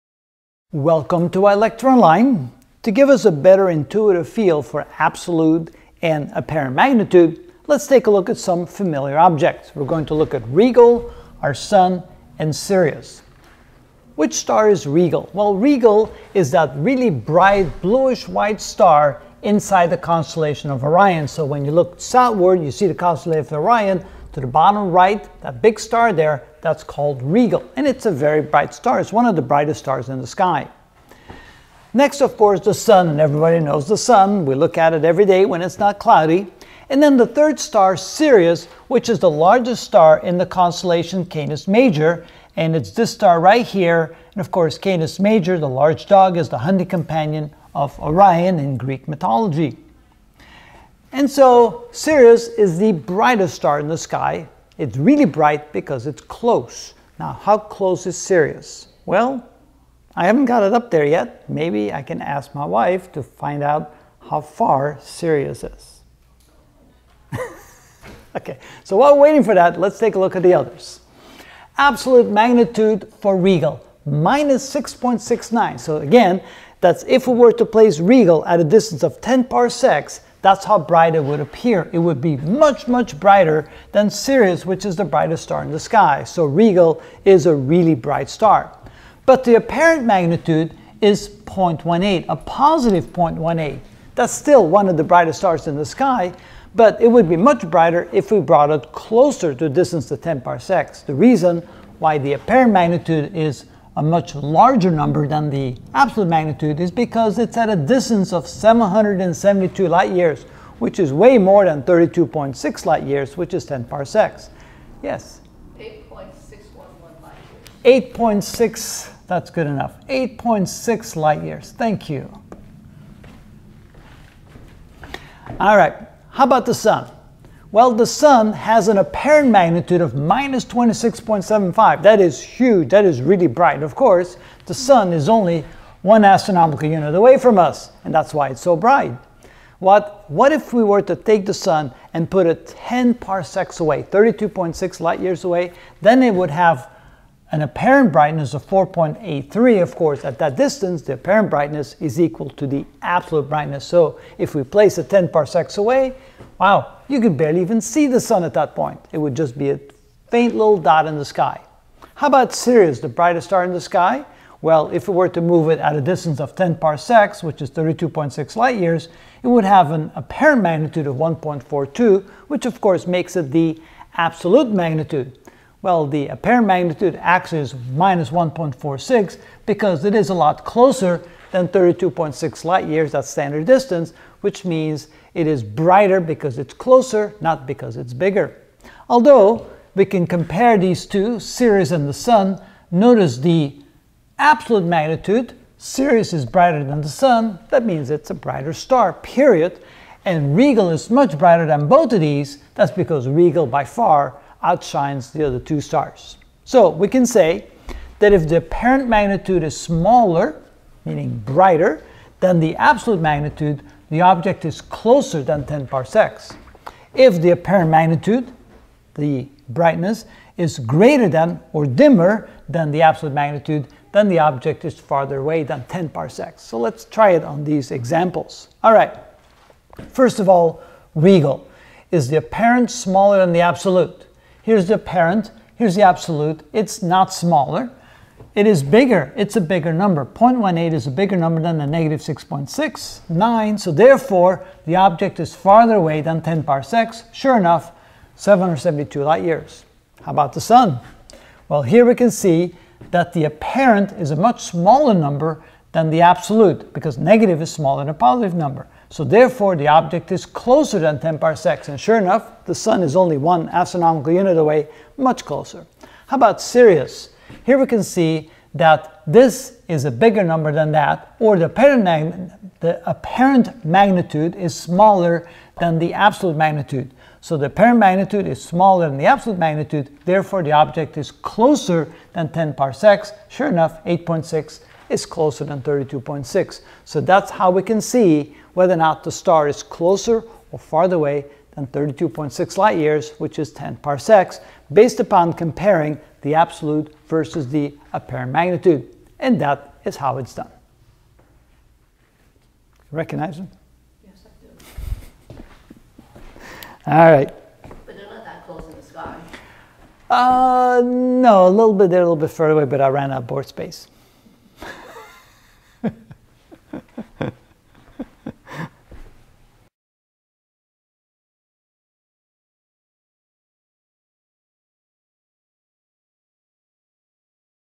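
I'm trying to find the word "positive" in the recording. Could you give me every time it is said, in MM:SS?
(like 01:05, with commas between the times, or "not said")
01:32, 04:18.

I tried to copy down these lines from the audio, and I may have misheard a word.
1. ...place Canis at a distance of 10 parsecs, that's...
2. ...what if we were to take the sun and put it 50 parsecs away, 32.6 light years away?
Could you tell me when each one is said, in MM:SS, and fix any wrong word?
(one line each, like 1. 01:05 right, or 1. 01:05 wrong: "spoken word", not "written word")
1. 01:17 wrong: "Rigel", not "Canis"
2. 02:20 wrong: "10", not "50".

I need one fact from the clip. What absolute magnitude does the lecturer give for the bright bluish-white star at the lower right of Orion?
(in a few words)
-6.69.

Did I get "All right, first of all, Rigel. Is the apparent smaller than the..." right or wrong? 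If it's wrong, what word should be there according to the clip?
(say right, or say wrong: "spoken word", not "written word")
right.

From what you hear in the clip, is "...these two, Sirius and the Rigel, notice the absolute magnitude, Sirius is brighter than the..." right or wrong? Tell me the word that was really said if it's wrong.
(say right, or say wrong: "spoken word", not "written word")
wrong: "Sun", not "Rigel".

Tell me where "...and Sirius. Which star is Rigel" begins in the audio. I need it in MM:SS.
00:12.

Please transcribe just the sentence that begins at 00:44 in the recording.
And of course, Canis Major, the large dog, is the hunting companion of Orion in Greek mythology.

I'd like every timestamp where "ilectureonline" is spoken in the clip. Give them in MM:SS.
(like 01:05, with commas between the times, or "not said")
00:01.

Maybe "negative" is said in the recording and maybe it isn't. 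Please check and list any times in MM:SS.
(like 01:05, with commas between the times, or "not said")
04:01, 04:17.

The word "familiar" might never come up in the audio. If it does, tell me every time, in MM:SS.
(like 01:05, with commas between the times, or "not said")
00:08.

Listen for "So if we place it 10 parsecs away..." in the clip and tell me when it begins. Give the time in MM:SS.
02:33.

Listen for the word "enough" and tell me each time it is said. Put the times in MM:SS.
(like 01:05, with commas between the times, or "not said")
01:59, 04:07, 04:22, 04:43.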